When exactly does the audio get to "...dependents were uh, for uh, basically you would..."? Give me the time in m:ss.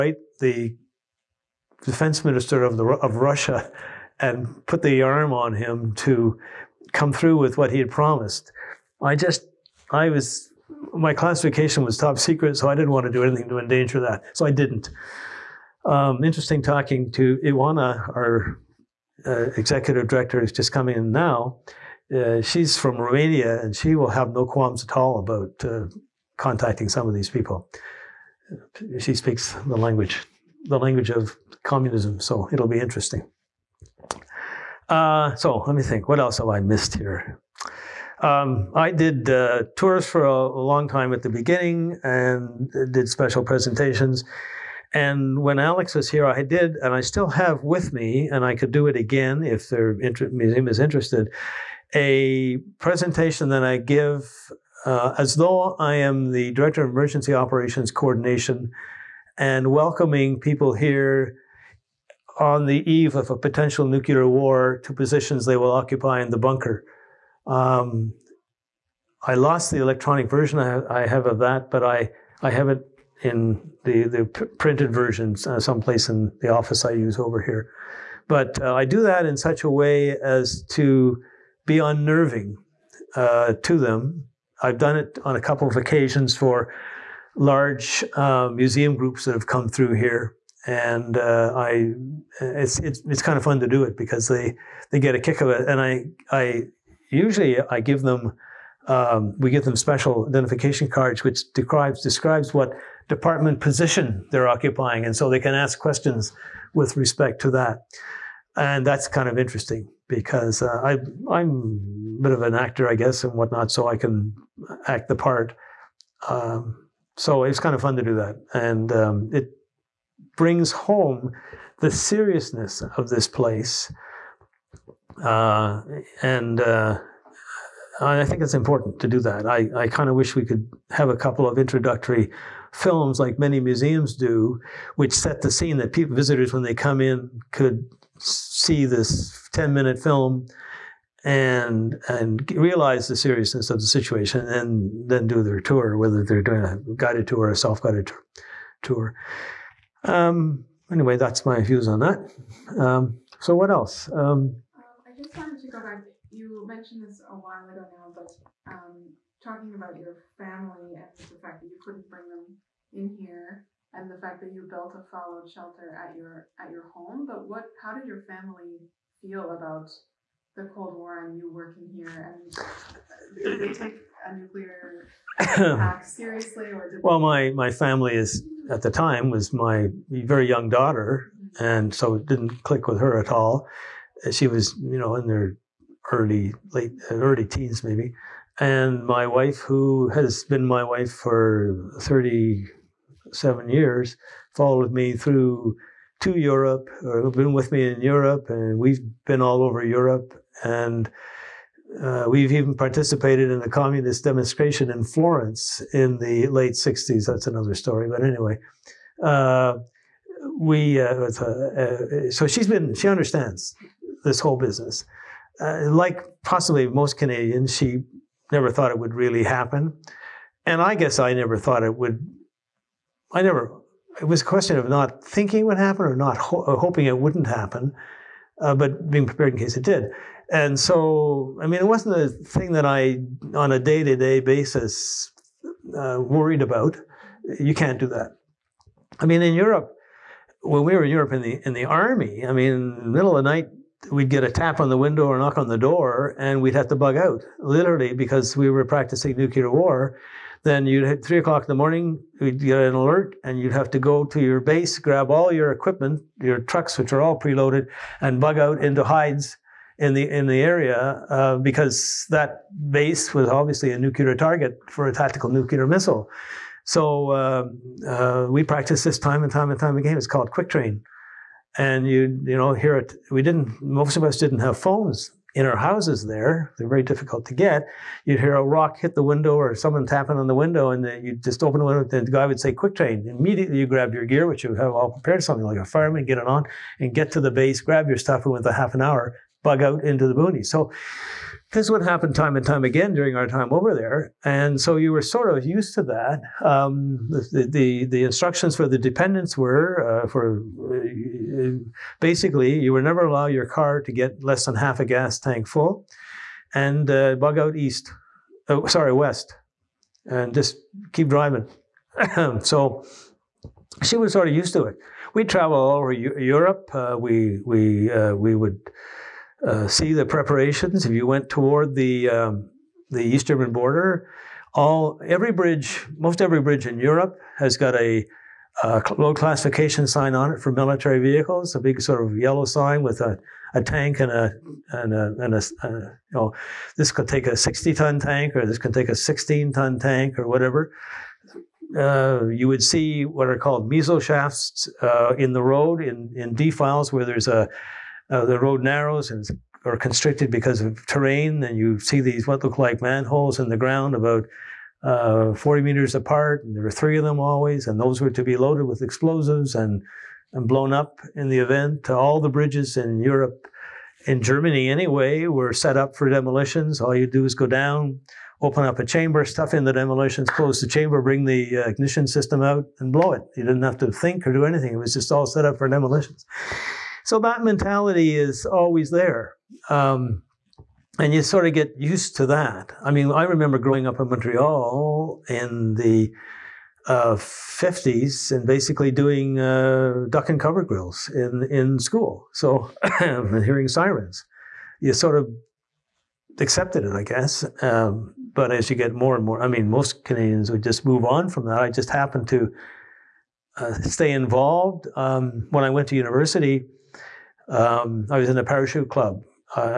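4:58.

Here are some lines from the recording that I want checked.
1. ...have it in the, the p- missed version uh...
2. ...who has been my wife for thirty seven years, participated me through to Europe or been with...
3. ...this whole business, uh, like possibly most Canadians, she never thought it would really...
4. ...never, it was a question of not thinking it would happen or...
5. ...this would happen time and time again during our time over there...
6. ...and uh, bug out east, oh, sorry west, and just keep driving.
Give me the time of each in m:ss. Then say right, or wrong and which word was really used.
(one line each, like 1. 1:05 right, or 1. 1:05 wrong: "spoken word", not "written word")
1. 1:12 wrong: "printed", not "missed"
2. 3:09 wrong: "followed", not "participated"
3. 3:34 right
4. 3:43 right
5. 4:51 right
6. 5:06 right.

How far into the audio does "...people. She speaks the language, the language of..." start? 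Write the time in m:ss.
0:27.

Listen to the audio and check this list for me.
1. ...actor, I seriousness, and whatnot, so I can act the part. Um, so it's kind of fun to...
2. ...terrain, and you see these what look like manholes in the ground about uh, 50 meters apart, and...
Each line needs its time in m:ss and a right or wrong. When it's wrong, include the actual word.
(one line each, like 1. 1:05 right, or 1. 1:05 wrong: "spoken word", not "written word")
1. 1:52 wrong: "guess", not "seriousness"
2. 5:51 wrong: "40", not "50".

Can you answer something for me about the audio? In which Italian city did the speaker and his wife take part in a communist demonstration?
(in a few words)
Florence.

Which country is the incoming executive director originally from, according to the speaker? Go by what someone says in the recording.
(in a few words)
Romania.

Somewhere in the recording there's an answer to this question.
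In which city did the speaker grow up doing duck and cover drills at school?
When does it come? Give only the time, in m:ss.
6:24.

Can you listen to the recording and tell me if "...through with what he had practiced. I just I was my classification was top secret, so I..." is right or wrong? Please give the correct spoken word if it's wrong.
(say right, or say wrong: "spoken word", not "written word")
wrong: "promised", not "practiced".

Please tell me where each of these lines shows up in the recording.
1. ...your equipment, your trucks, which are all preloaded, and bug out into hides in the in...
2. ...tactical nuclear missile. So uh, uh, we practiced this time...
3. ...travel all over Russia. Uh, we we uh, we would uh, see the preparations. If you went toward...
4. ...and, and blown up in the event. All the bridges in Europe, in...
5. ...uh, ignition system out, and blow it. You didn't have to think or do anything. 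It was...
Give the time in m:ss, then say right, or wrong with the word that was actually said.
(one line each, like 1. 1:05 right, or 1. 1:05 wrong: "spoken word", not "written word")
1. 4:15 right
2. 4:25 right
3. 5:15 wrong: "Europe", not "Russia"
4. 5:59 right
5. 6:11 right.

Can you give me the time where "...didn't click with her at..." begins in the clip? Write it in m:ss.
3:02.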